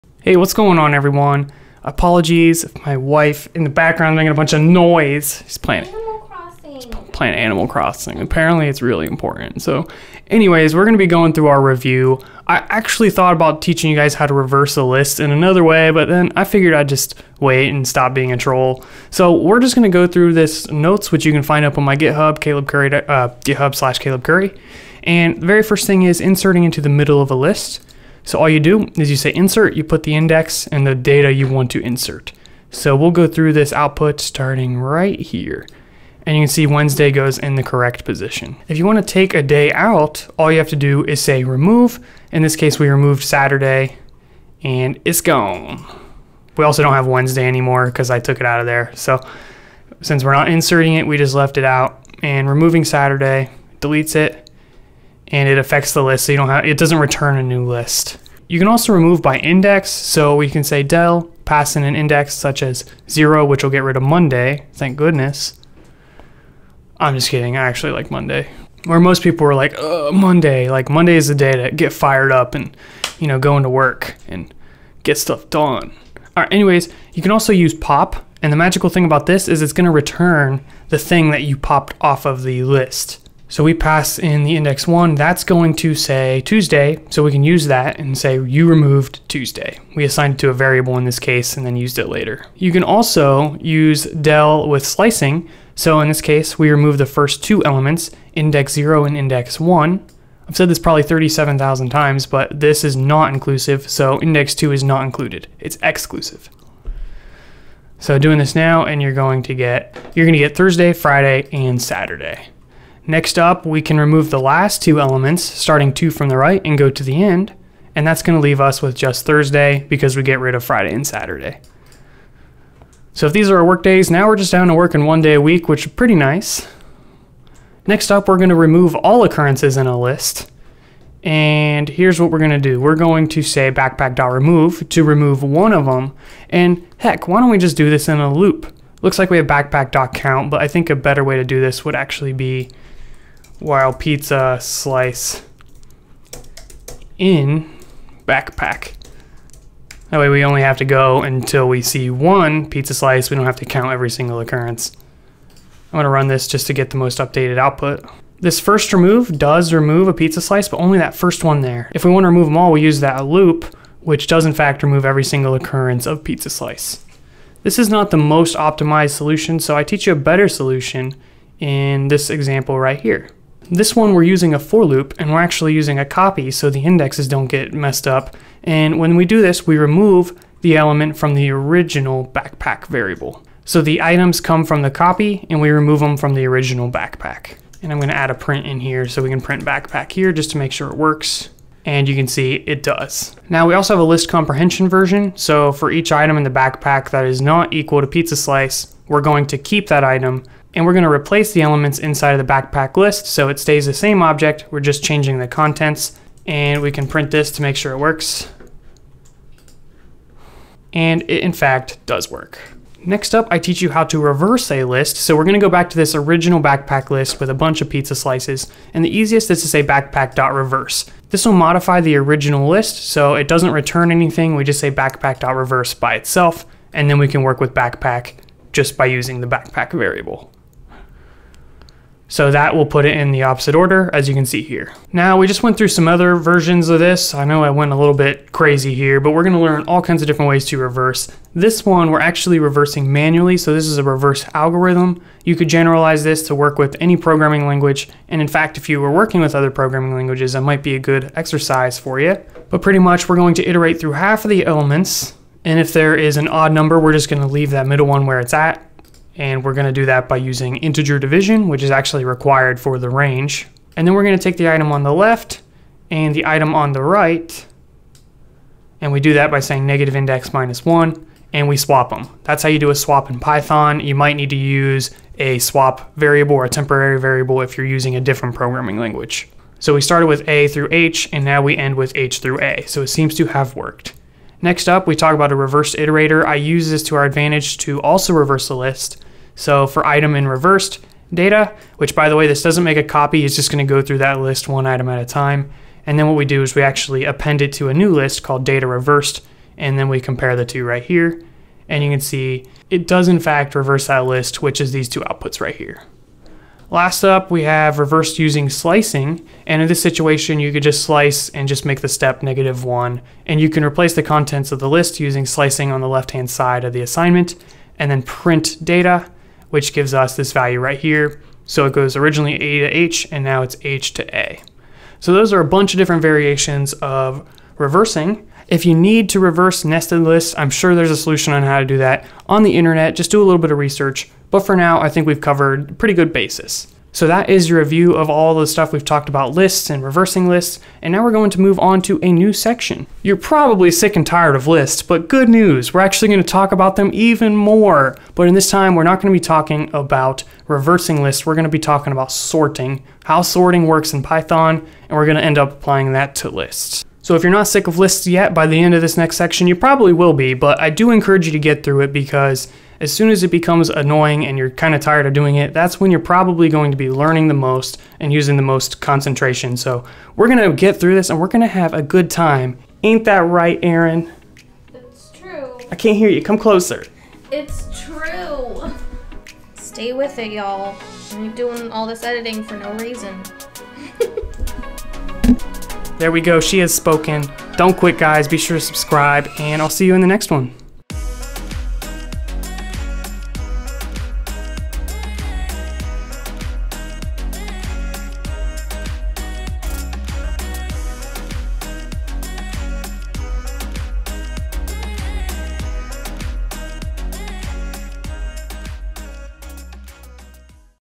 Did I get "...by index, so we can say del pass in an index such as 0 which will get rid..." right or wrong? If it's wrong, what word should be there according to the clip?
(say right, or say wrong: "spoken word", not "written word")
right.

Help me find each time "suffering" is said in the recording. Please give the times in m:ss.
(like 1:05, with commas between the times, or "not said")
not said.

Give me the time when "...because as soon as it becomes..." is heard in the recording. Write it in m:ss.
6:02.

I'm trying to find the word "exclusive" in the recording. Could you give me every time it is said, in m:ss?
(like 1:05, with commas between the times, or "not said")
1:45.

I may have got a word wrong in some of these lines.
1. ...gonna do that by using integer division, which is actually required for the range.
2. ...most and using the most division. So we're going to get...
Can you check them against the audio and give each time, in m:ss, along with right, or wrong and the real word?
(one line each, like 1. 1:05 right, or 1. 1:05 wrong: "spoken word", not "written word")
1. 4:19 right
2. 6:07 wrong: "concentration", not "division".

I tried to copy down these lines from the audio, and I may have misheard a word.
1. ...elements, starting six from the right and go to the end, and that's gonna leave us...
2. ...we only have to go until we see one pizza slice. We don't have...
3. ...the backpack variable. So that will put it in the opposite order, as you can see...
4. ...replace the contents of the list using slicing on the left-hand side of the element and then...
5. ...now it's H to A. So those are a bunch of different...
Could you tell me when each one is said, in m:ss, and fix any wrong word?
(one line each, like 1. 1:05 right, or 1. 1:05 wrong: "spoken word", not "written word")
1. 1:55 wrong: "two", not "six"
2. 2:30 right
3. 3:49 right
4. 5:13 wrong: "assignment", not "element"
5. 5:23 right.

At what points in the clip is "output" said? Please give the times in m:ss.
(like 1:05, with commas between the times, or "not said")
0:33, 2:37, 5:05.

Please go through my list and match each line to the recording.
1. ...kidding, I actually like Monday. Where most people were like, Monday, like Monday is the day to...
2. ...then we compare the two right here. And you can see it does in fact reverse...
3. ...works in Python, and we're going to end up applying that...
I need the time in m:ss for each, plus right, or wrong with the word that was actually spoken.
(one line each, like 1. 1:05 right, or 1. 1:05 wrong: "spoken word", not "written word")
1. 1:07 right
2. 4:59 right
3. 5:53 right.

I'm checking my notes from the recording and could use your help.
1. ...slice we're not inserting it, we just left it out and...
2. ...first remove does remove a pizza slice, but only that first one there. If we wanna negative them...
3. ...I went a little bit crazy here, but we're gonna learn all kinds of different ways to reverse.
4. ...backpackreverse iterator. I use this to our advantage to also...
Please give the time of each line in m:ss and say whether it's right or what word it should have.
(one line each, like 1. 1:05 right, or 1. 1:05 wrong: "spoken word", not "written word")
1. 0:50 wrong: "since", not "slice"
2. 2:38 wrong: "remove", not "negative"
3. 3:57 right
4. 4:45 wrong: "reverse", not "backpackreverse".